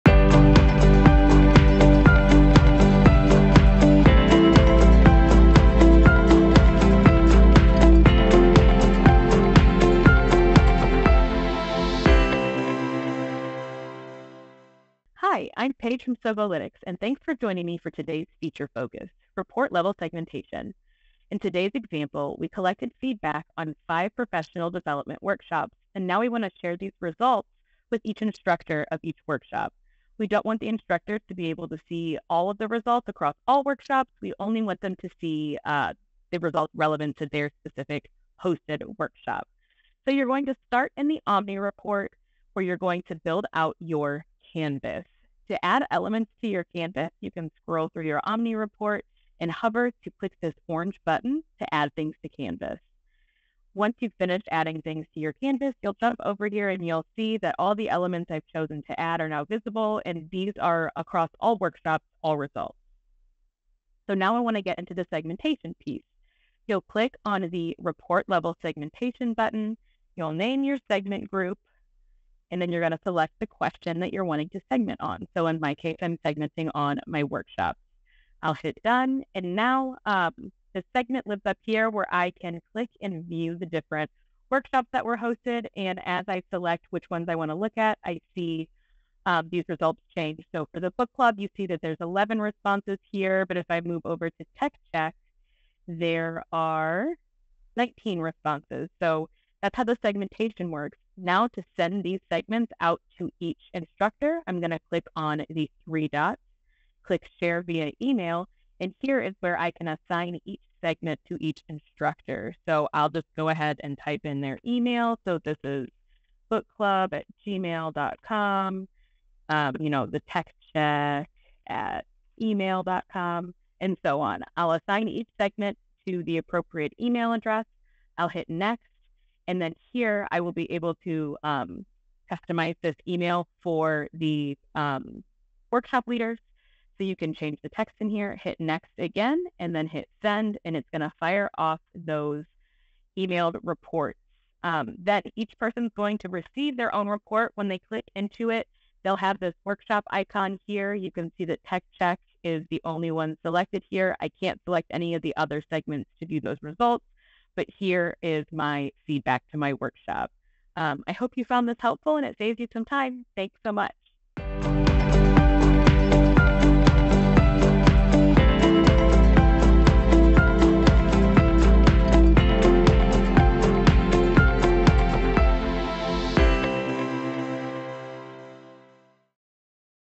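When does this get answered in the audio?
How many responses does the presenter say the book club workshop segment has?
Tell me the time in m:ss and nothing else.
1:32.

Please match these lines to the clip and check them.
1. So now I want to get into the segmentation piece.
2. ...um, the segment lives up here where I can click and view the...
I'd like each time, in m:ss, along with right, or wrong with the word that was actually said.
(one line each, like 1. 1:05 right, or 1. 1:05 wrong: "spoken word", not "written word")
1. 1:04 right
2. 1:20 right.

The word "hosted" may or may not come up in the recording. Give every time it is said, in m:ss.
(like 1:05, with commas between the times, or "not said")
0:38, 1:25.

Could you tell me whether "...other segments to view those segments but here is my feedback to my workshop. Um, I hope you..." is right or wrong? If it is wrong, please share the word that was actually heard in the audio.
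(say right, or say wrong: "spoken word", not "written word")
wrong: "results", not "segments".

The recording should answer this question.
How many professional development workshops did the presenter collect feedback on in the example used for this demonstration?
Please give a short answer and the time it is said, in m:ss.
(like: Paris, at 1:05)
5, at 0:23.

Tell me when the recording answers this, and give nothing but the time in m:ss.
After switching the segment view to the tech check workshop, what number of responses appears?
1:37.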